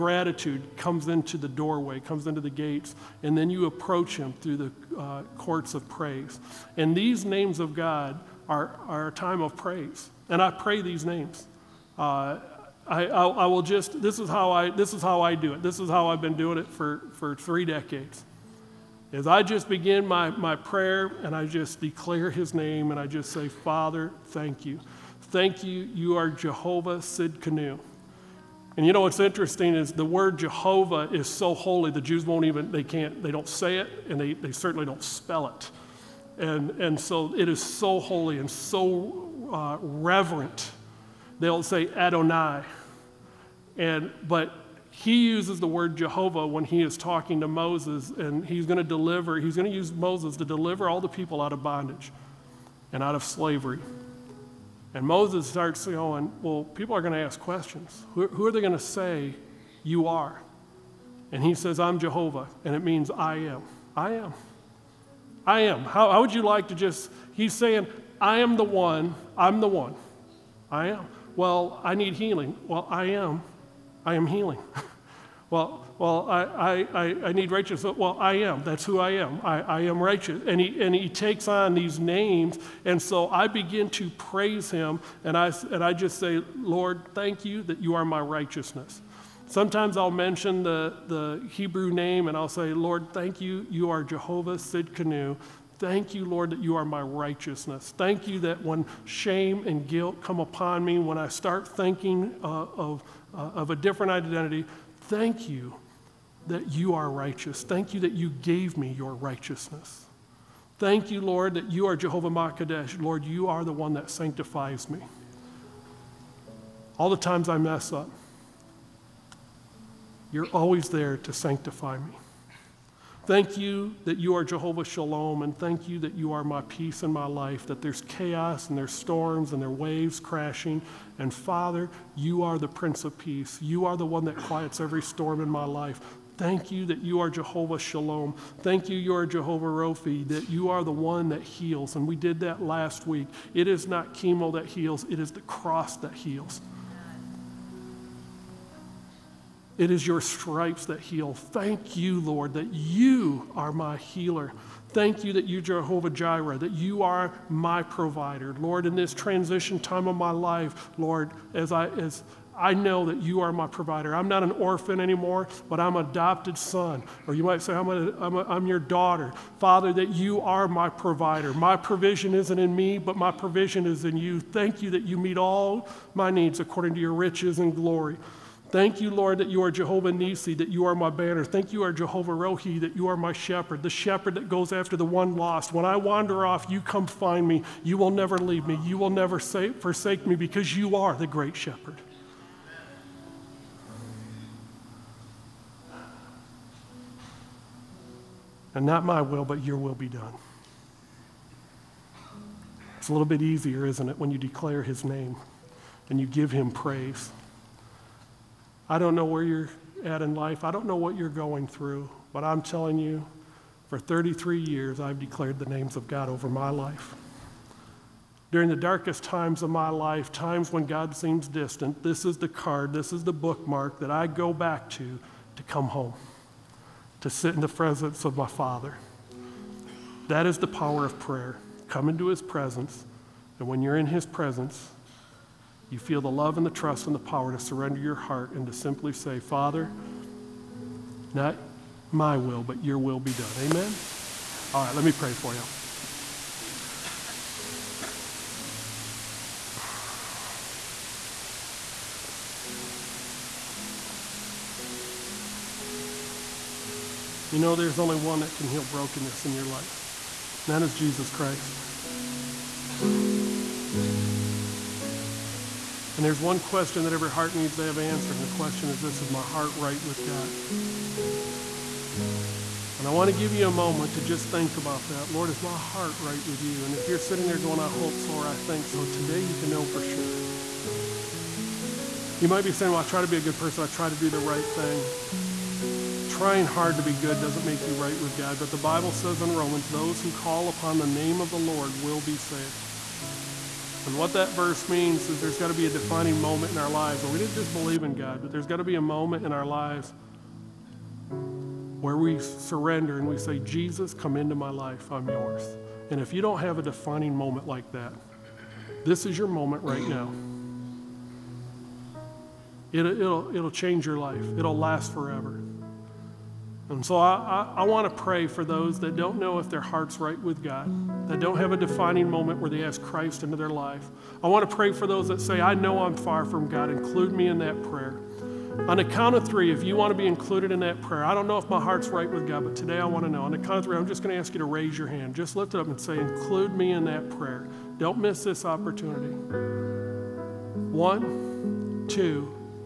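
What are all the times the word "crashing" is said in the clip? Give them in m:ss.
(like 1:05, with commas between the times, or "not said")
2:10.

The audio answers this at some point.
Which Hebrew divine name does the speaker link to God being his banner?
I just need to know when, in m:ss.
2:59.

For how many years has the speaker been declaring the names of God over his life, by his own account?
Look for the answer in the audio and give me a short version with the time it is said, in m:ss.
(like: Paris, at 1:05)
33, at 3:33.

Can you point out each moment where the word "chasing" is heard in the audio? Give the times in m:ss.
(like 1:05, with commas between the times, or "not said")
not said.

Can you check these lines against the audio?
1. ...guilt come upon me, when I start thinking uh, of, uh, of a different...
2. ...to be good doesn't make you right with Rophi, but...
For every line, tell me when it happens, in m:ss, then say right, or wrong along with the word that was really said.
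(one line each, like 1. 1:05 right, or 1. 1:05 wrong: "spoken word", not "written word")
1. 1:39 right
2. 4:46 wrong: "God", not "Rophi".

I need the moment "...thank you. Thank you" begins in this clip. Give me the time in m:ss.
0:24.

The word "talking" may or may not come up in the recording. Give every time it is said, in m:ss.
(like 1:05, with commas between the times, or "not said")
0:46.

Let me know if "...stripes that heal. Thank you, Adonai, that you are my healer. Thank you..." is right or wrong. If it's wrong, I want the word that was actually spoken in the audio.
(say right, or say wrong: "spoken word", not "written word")
wrong: "Lord", not "Adonai".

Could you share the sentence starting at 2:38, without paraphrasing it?
Lord, in this transition time of my life, Lord, as I as I know that you are my provider.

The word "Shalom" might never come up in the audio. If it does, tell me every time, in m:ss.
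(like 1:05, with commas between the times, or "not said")
2:04, 2:17.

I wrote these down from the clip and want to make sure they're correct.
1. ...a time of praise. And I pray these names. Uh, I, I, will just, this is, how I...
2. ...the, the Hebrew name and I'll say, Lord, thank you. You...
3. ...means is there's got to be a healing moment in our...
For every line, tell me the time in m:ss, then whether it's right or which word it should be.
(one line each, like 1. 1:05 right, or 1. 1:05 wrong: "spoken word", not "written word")
1. 0:09 right
2. 1:30 right
3. 4:54 wrong: "defining", not "healing".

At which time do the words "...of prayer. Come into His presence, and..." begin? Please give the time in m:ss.
3:51.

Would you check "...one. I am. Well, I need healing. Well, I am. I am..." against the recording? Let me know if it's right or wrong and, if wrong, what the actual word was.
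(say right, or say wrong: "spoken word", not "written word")
right.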